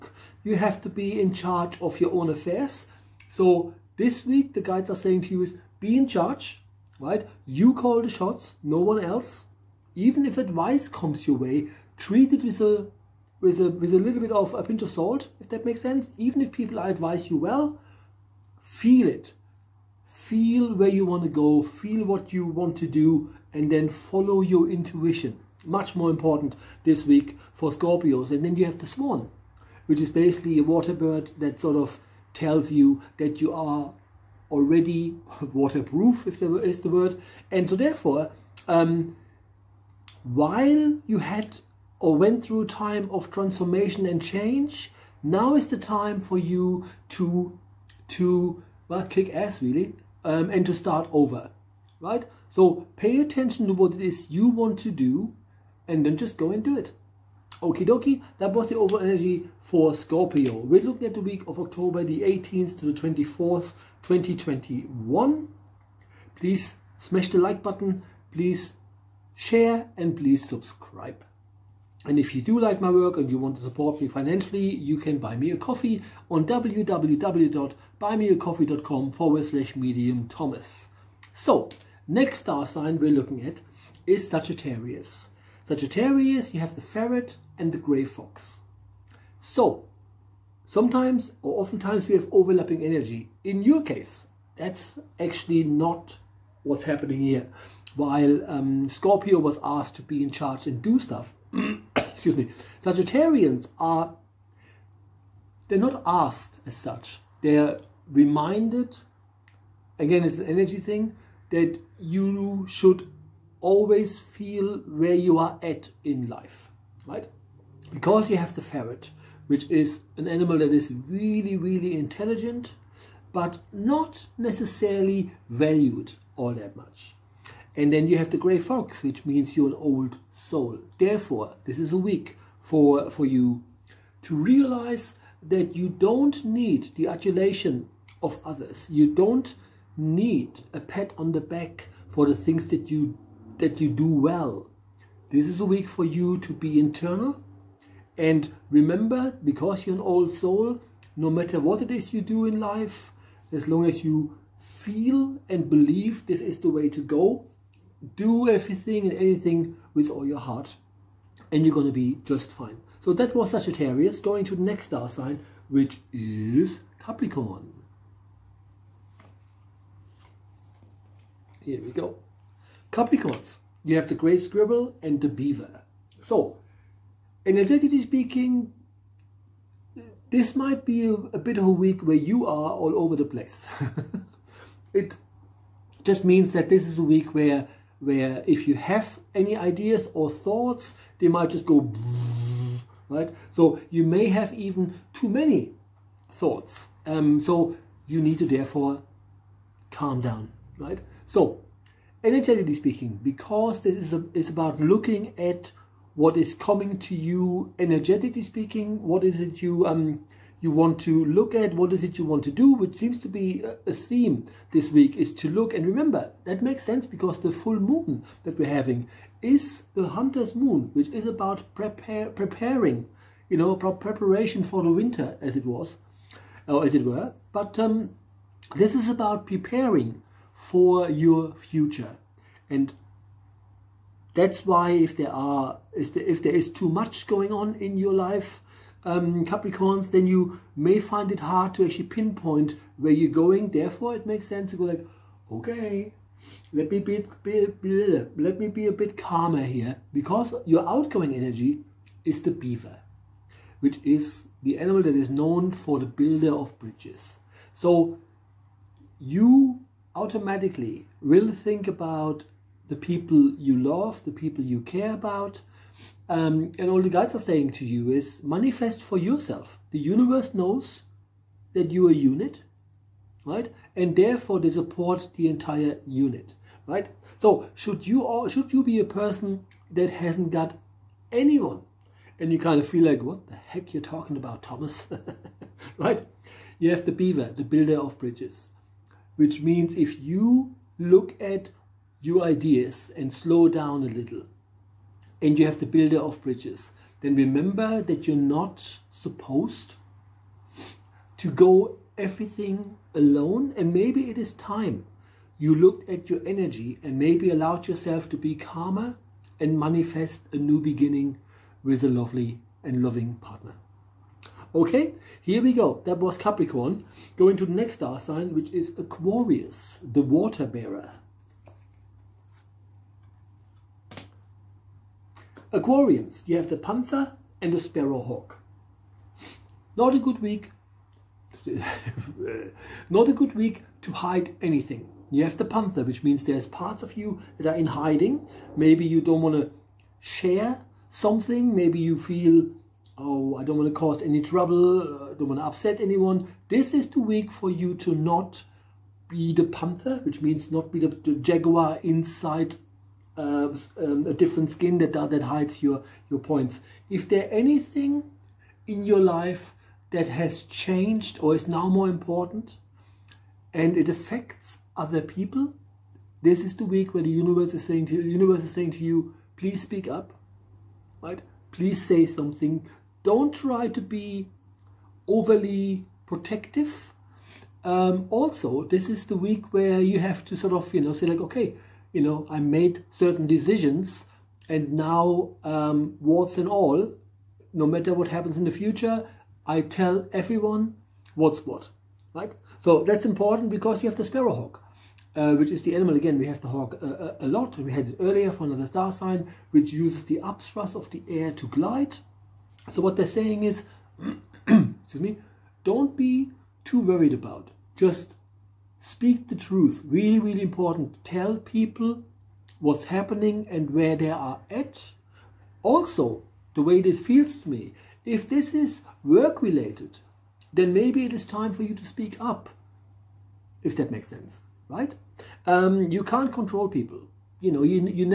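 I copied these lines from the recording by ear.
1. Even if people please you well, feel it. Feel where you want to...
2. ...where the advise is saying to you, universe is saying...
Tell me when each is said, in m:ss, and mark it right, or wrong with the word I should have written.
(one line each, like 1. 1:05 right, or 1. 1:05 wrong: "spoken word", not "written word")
1. 0:16 wrong: "advise", not "please"
2. 6:07 wrong: "universe", not "advise".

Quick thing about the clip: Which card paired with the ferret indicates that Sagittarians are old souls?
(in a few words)
Grey fox.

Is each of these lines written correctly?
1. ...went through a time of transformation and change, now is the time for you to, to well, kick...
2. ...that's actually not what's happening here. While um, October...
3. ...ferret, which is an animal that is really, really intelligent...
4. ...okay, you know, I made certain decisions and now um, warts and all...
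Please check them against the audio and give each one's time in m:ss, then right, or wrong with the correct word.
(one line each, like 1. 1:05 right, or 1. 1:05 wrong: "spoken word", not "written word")
1. 0:42 right
2. 1:34 wrong: "Scorpio", not "October"
3. 1:58 right
4. 6:21 right.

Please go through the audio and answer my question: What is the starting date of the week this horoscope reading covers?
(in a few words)
October 18.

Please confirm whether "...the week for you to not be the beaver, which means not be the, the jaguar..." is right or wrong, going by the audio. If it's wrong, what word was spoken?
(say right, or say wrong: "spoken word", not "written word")
wrong: "panther", not "beaver".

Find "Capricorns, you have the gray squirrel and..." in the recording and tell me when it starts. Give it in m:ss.
2:52.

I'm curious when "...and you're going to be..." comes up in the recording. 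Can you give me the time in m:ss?
2:41.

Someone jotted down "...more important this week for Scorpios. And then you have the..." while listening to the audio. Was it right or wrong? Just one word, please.
right.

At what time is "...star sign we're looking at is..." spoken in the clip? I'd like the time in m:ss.
1:22.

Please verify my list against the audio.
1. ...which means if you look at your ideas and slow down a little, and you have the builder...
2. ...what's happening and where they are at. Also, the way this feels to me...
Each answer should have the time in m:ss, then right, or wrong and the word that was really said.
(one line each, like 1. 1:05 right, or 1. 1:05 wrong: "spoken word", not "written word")
1. 4:49 right
2. 6:52 right.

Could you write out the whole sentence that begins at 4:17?
So you automatically will think about the people you love, the people you care about.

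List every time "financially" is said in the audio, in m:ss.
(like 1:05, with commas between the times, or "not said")
1:14.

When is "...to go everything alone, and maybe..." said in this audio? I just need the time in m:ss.
5:01.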